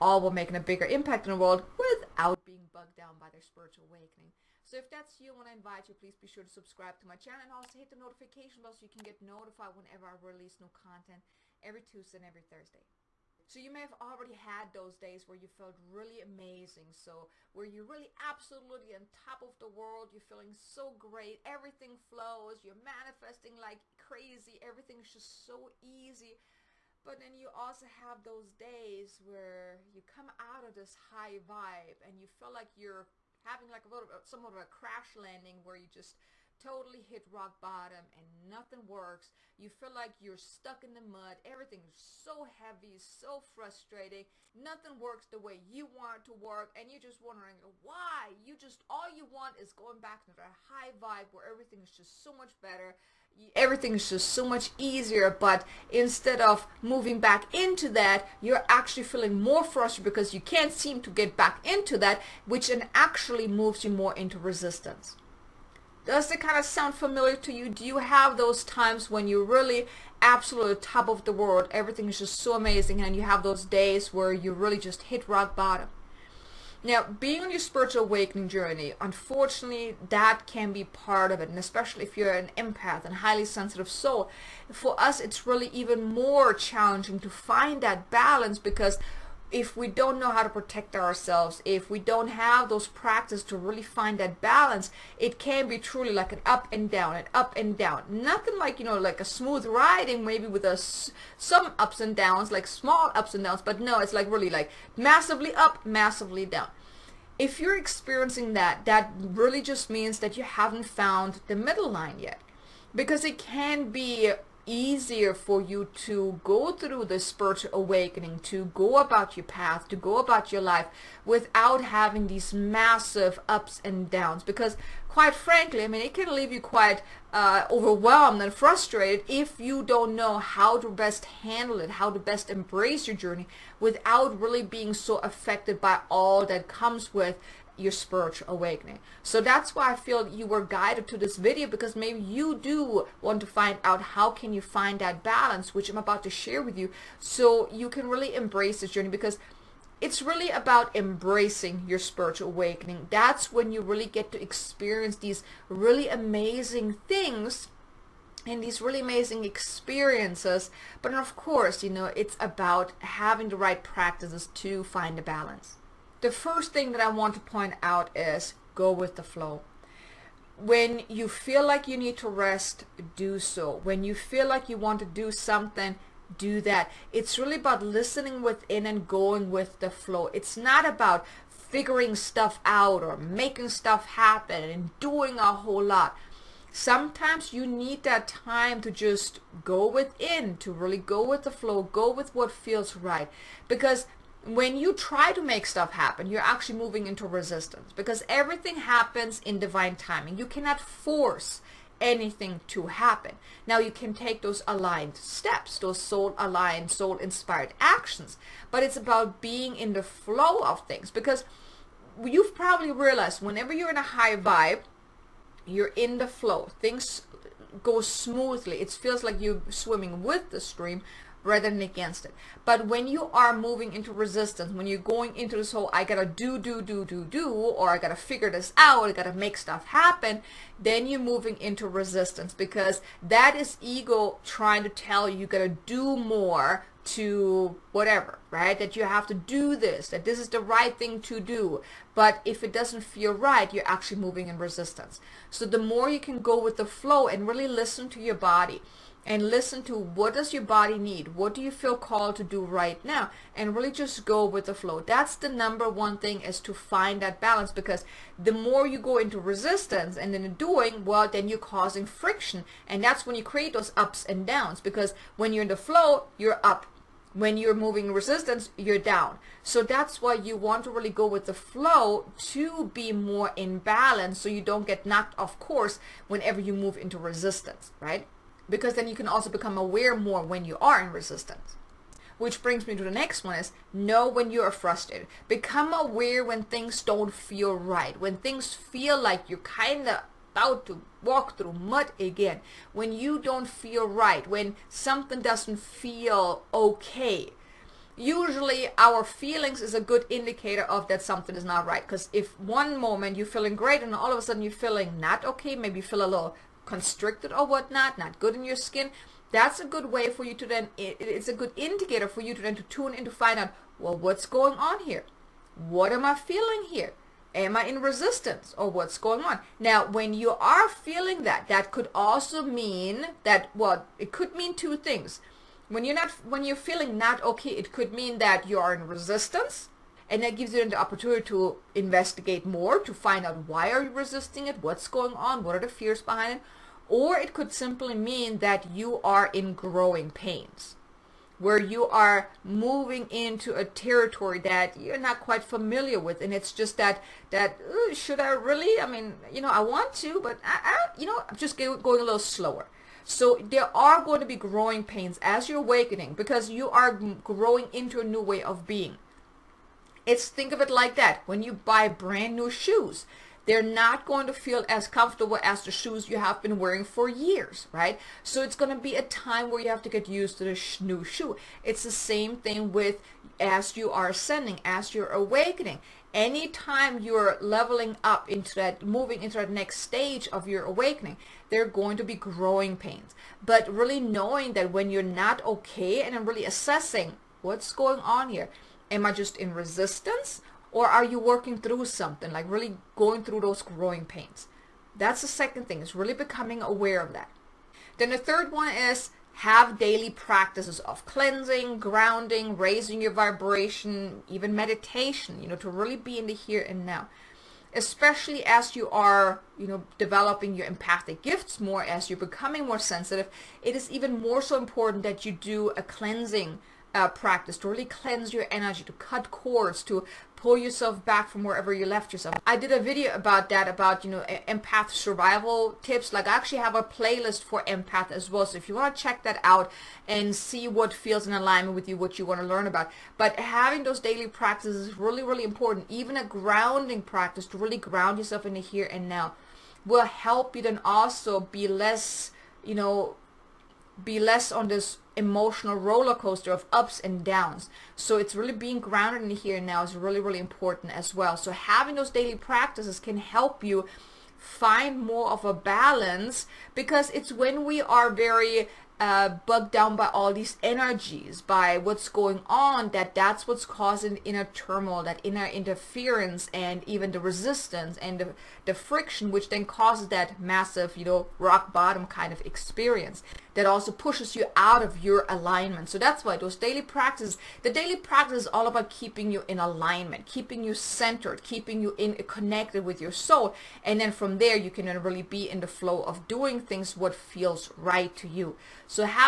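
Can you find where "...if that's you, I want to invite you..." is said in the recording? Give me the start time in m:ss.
0:04.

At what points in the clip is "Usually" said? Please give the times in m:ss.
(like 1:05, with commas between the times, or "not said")
4:58.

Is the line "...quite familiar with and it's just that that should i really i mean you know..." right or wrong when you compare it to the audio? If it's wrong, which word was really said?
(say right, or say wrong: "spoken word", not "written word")
right.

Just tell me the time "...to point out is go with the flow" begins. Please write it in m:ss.
2:47.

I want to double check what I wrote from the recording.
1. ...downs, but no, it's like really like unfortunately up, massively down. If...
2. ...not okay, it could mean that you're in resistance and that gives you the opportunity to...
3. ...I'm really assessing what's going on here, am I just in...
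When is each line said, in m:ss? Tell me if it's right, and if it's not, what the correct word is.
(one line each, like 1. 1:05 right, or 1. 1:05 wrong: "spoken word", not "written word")
1. 1:43 wrong: "massively", not "unfortunately"
2. 5:27 right
3. 6:26 right.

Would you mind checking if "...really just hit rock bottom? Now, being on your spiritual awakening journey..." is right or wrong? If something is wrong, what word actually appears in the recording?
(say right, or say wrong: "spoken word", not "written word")
right.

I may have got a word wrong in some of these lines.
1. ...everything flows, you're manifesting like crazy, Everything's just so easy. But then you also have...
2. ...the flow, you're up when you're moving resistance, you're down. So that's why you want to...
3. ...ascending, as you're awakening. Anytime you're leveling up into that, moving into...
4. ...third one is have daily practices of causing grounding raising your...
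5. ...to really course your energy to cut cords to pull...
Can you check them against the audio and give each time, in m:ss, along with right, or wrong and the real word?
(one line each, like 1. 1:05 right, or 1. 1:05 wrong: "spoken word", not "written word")
1. 0:21 right
2. 4:25 right
3. 6:14 right
4. 6:38 wrong: "cleansing", not "causing"
5. 6:57 wrong: "cleanse", not "course".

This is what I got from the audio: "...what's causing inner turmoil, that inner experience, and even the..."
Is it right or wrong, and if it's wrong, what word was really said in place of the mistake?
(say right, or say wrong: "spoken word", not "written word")
wrong: "interference", not "experience".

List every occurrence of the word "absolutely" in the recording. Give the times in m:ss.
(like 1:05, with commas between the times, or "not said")
0:18, 1:10.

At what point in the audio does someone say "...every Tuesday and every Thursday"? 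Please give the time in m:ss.
0:11.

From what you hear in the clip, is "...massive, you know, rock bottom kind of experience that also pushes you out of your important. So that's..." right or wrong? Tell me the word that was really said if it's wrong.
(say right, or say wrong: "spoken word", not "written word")
wrong: "alignment", not "important".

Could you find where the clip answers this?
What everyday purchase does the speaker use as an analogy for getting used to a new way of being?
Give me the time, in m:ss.
6:02.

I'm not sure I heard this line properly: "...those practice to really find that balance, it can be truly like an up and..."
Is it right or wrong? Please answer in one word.
right.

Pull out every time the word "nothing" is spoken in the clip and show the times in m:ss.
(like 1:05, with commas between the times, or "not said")
0:38, 0:44, 1:38.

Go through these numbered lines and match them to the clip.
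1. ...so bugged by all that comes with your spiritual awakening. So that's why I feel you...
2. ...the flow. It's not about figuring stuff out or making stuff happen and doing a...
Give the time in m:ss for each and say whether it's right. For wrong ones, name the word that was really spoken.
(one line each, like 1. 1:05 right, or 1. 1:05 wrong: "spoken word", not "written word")
1. 2:14 wrong: "affected", not "bugged"
2. 2:59 right.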